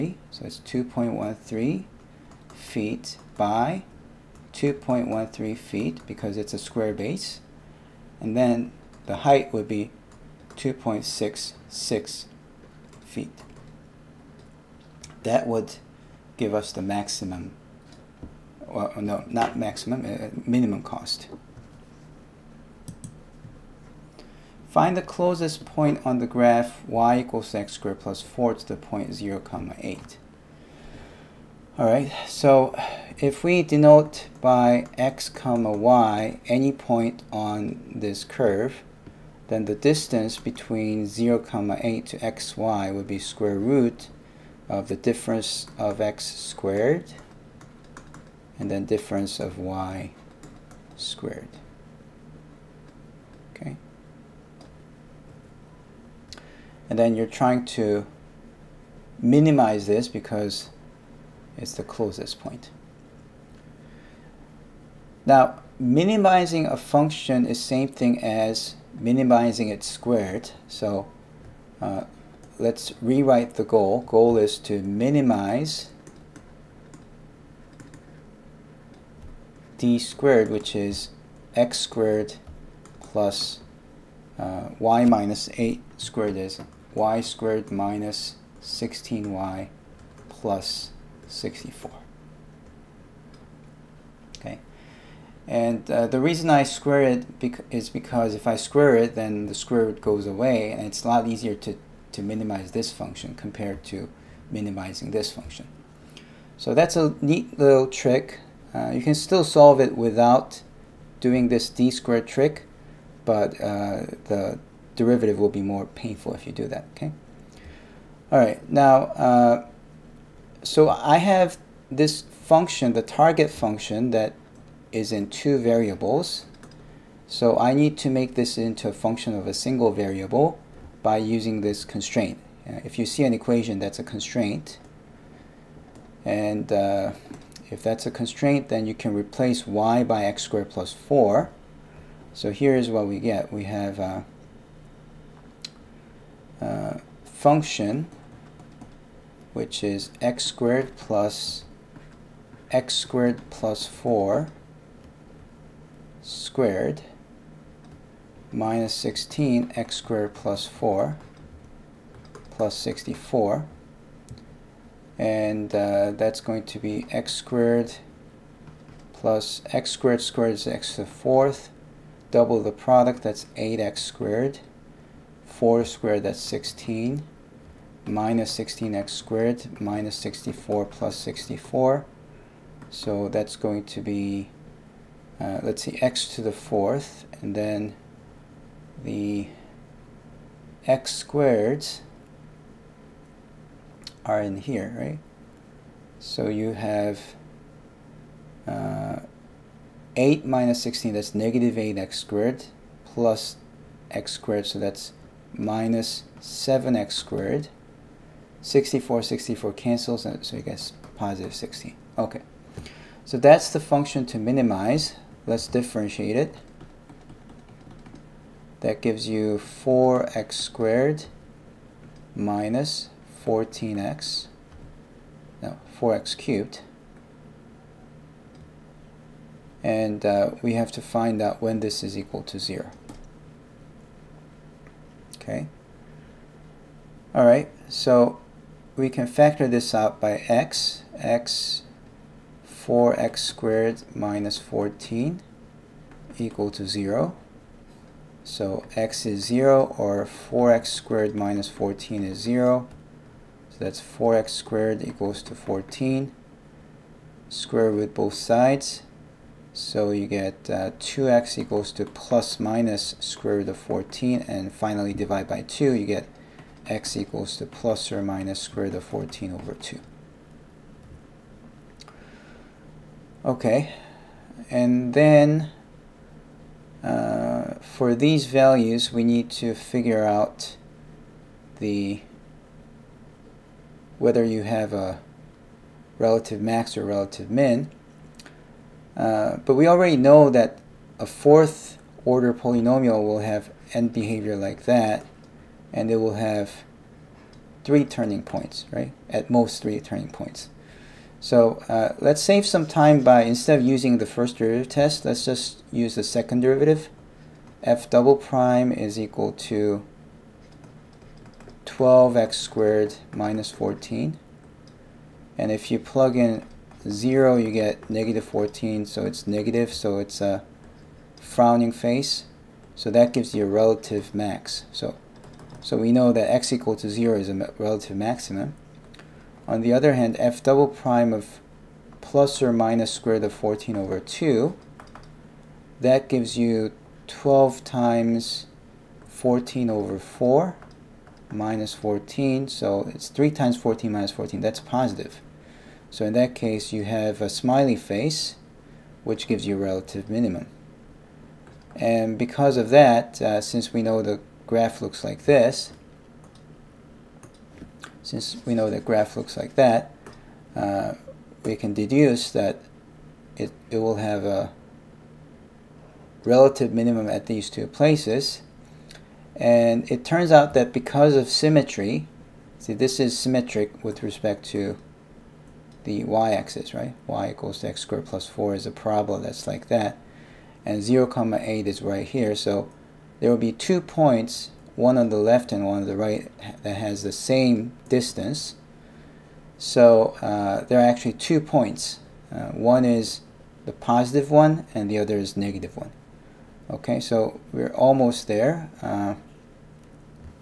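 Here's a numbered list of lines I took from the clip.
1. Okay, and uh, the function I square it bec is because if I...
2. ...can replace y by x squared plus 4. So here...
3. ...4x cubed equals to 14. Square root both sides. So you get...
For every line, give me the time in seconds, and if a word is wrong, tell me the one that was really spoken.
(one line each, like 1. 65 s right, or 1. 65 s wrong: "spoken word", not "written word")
1. 94 s wrong: "reason", not "function"
2. 138 s right
3. 254 s wrong: "squared", not "cubed".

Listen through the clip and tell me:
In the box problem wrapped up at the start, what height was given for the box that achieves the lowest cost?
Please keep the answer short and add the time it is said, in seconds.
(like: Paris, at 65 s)
2.66 feet, at 10 s.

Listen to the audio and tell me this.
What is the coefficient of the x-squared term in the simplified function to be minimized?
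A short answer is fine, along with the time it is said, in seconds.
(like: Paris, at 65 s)
-7, at 205 s.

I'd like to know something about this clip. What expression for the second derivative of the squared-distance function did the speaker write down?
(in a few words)
12x^2 - 14.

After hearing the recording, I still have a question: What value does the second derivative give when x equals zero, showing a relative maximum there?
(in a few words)
-14.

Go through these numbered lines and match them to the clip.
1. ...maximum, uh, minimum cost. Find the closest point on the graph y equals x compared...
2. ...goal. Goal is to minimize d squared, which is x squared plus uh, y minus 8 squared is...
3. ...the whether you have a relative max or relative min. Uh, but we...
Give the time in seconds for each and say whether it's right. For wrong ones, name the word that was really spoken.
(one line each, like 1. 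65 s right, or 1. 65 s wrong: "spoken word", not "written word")
1. 19 s wrong: "squared", not "compared"
2. 73 s right
3. 281 s right.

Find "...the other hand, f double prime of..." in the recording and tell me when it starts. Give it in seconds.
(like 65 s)
329 s.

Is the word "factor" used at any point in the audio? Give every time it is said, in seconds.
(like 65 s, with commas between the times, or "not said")
239 s.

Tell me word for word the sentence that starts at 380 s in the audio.
And 0, comma 8 is right here.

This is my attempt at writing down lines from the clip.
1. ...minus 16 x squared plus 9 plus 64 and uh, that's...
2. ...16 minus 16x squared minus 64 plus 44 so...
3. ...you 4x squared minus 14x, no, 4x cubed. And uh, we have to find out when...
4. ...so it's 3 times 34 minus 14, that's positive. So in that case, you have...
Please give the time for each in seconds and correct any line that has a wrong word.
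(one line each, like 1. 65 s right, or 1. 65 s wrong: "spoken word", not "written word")
1. 158 s wrong: "4", not "9"
2. 176 s wrong: "64", not "44"
3. 219 s right
4. 342 s wrong: "14", not "34".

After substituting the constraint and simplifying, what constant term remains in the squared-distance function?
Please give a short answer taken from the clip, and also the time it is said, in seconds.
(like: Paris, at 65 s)
16, at 211 s.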